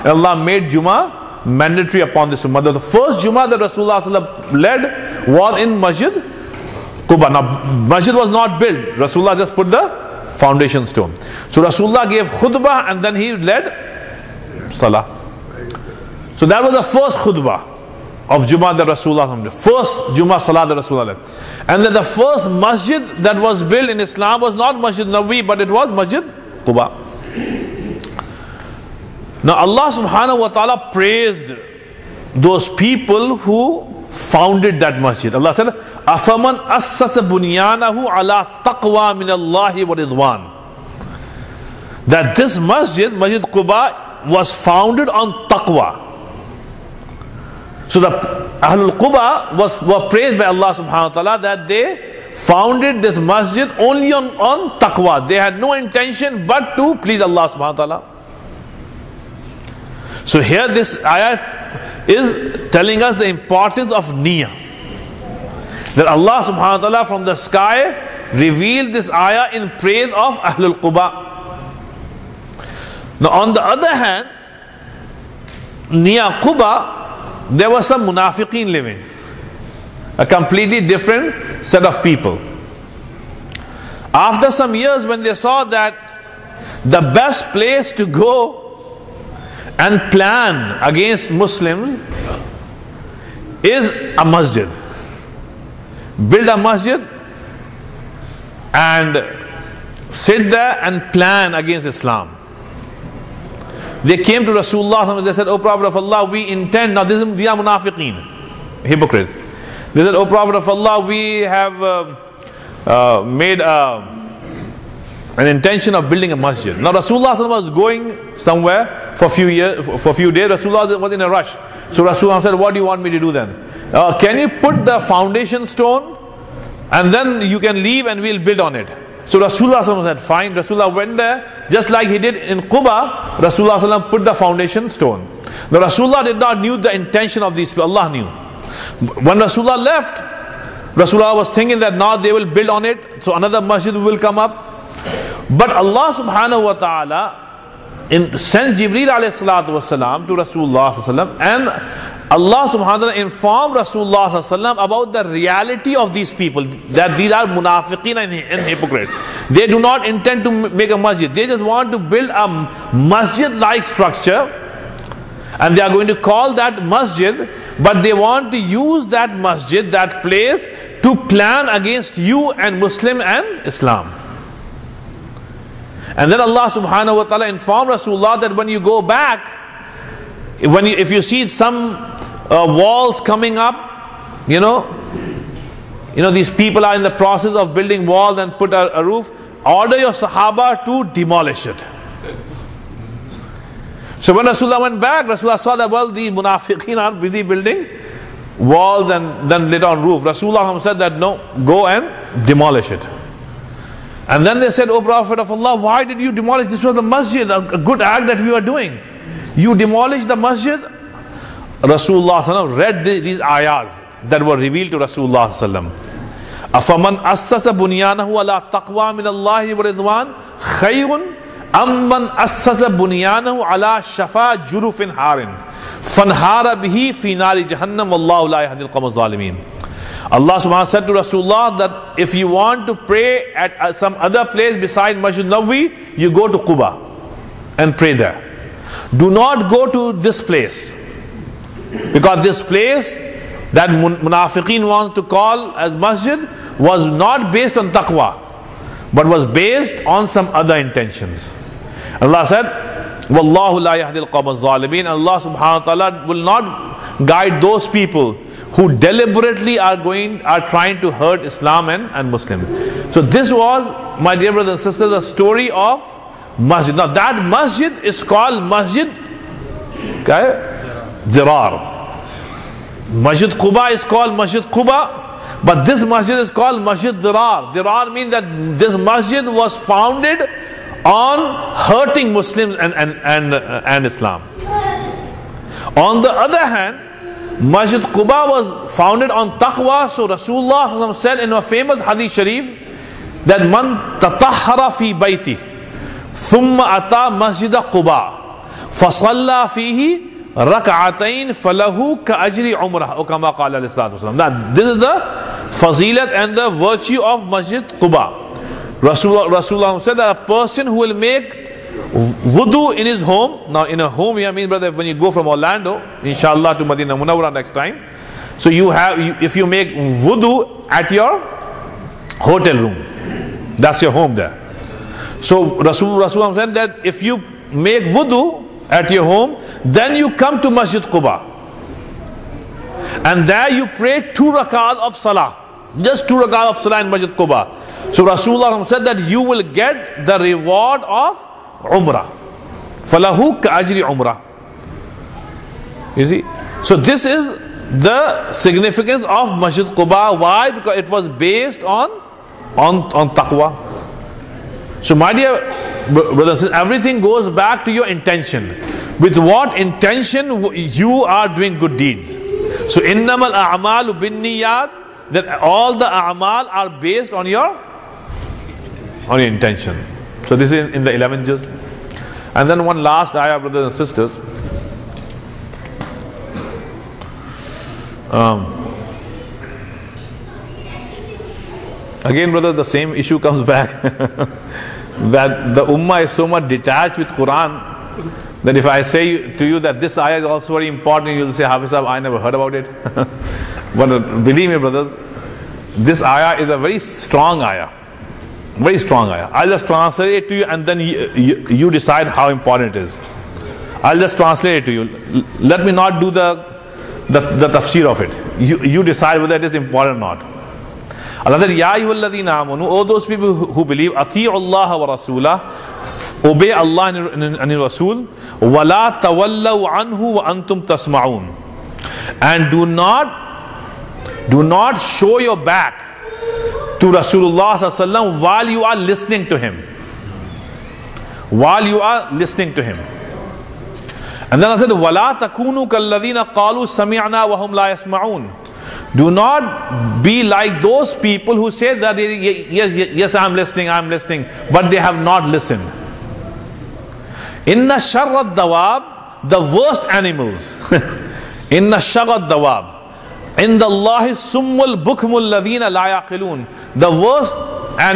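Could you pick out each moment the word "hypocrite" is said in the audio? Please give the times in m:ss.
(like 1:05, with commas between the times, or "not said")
1:48, 2:38.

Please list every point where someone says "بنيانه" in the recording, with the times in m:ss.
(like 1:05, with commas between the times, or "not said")
3:37, 3:42.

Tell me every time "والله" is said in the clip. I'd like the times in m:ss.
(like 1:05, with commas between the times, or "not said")
3:48.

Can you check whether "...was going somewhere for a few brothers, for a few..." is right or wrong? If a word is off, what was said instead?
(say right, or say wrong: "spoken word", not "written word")
wrong: "years", not "brothers".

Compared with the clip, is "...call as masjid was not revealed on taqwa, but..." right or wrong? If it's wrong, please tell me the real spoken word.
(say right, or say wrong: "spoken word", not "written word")
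wrong: "based", not "revealed".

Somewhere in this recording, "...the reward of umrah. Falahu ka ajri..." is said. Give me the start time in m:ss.
5:40.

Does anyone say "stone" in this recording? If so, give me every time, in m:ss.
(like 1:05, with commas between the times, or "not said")
0:10, 2:05, 2:14.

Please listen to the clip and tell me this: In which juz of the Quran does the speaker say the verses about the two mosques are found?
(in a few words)
11th juz.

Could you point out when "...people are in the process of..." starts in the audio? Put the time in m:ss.
3:06.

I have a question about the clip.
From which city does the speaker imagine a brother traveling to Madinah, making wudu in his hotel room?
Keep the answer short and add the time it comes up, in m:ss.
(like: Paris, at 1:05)
Orlando, at 5:15.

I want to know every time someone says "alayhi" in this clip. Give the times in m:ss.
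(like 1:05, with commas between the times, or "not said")
2:29.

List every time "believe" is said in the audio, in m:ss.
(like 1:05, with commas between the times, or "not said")
6:34, 6:53.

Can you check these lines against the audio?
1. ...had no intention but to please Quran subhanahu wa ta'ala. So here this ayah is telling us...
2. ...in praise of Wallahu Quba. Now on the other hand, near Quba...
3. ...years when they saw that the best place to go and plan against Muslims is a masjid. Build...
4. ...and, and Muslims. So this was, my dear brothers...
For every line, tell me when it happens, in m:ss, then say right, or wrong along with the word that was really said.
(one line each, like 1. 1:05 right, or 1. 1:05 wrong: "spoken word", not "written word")
1. 0:55 wrong: "Allah", not "Quran"
2. 1:09 wrong: "Ahlul", not "Wallahu"
3. 1:24 right
4. 4:21 right.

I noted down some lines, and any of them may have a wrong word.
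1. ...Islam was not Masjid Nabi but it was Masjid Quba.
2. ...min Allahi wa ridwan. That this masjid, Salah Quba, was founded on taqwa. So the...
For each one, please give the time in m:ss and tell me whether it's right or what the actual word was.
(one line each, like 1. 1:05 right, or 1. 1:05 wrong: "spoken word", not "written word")
1. 0:24 right
2. 0:39 wrong: "Masjid", not "Salah".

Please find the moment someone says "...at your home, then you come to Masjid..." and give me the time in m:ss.
5:28.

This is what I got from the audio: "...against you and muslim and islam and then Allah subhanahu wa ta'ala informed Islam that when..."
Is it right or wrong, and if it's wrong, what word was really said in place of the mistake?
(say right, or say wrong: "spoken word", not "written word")
wrong: "Rasulullah", not "Islam".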